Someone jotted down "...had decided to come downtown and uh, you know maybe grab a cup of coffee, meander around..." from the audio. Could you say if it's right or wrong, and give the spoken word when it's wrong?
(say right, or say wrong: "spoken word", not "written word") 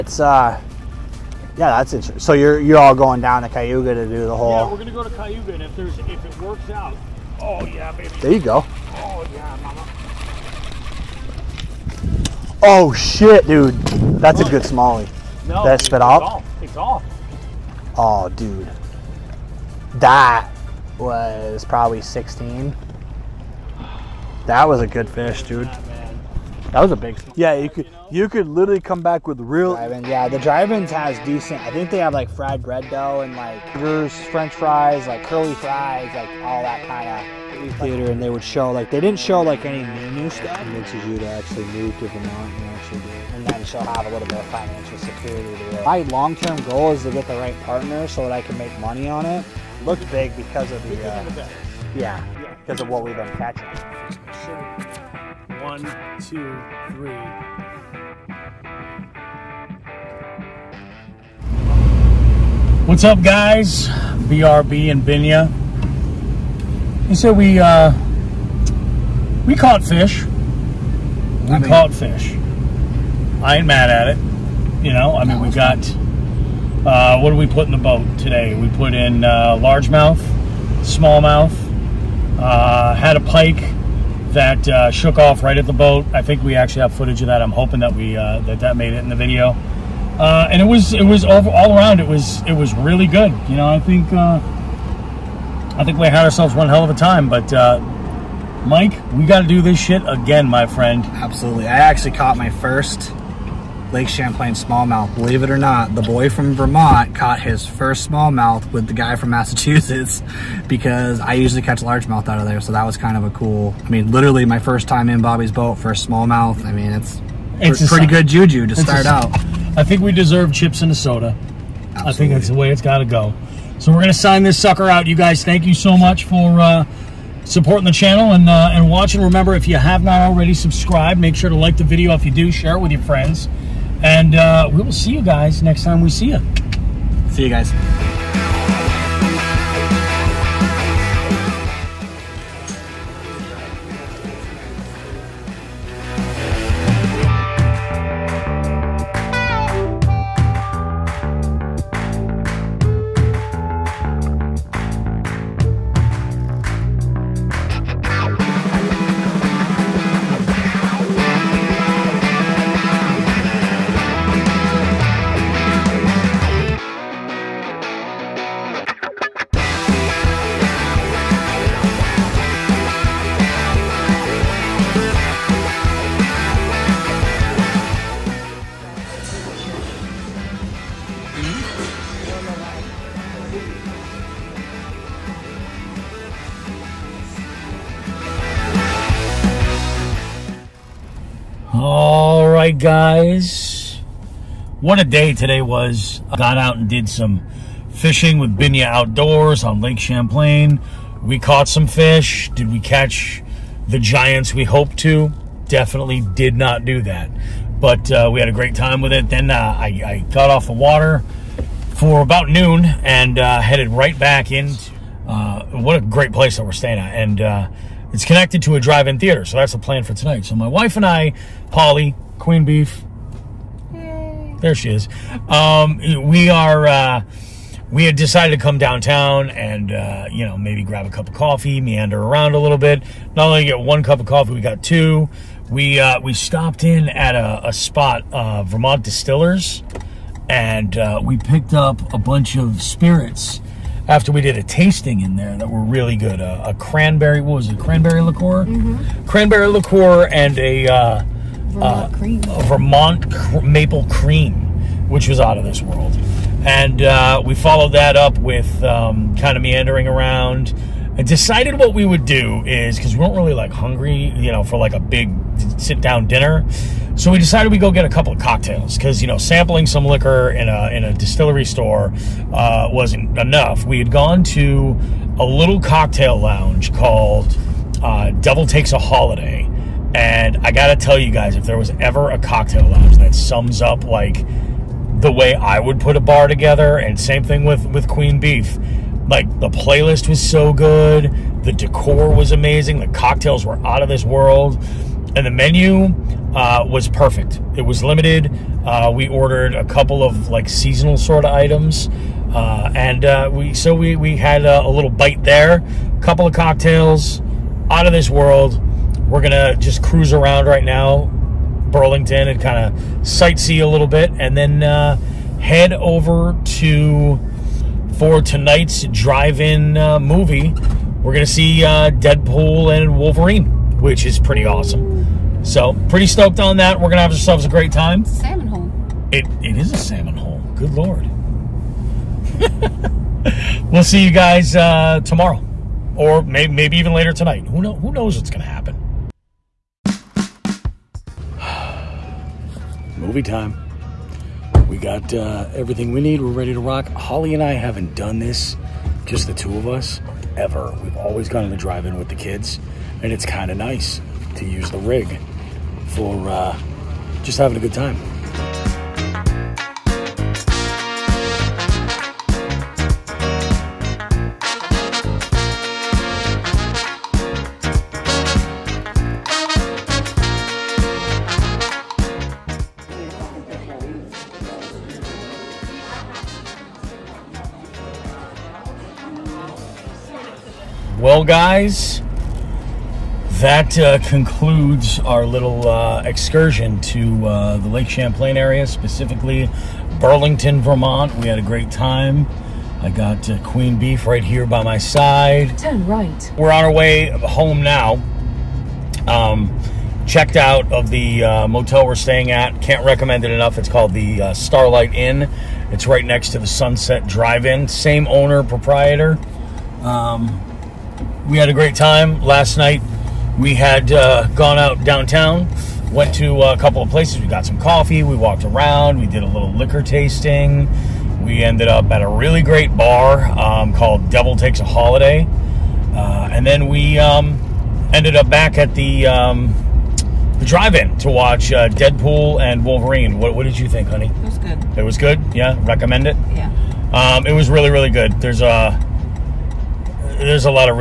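right.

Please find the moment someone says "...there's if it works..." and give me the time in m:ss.
0:05.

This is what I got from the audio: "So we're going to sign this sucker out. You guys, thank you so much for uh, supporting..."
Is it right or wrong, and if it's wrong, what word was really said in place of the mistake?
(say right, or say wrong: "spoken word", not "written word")
right.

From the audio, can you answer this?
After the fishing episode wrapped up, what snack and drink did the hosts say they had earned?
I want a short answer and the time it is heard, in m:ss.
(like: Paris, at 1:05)
Chips and a soda, at 2:00.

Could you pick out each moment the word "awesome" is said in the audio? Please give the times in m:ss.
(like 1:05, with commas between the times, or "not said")
5:24.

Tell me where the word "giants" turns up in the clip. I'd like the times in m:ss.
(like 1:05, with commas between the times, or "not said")
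3:23.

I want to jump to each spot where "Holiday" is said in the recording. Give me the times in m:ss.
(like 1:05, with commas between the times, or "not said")
4:38, 7:04.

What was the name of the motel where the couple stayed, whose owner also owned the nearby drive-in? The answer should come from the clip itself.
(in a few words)
Starlight Inn.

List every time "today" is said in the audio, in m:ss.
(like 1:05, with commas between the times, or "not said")
1:18, 3:15.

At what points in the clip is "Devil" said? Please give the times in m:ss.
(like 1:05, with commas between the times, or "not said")
4:38, 7:04.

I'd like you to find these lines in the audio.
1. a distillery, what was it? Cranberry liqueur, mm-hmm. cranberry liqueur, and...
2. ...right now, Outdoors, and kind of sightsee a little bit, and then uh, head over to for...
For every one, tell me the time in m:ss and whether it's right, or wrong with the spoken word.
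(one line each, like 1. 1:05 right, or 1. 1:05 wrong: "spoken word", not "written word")
1. 4:06 wrong: "cranberry", not "distillery"
2. 5:10 wrong: "Burlington", not "Outdoors".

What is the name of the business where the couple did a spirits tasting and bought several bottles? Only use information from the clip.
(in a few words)
Vermont Distillers.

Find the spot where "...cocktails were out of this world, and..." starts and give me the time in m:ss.
4:53.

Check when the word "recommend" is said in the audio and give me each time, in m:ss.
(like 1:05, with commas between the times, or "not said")
6:43, 7:15.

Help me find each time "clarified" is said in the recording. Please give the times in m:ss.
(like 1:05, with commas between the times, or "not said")
not said.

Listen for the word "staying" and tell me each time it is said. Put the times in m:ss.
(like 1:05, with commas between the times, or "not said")
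3:36, 6:42.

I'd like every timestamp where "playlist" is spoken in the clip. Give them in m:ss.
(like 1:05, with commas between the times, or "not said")
4:49.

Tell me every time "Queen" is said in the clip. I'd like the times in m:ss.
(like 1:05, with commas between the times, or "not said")
3:42, 4:48, 6:33.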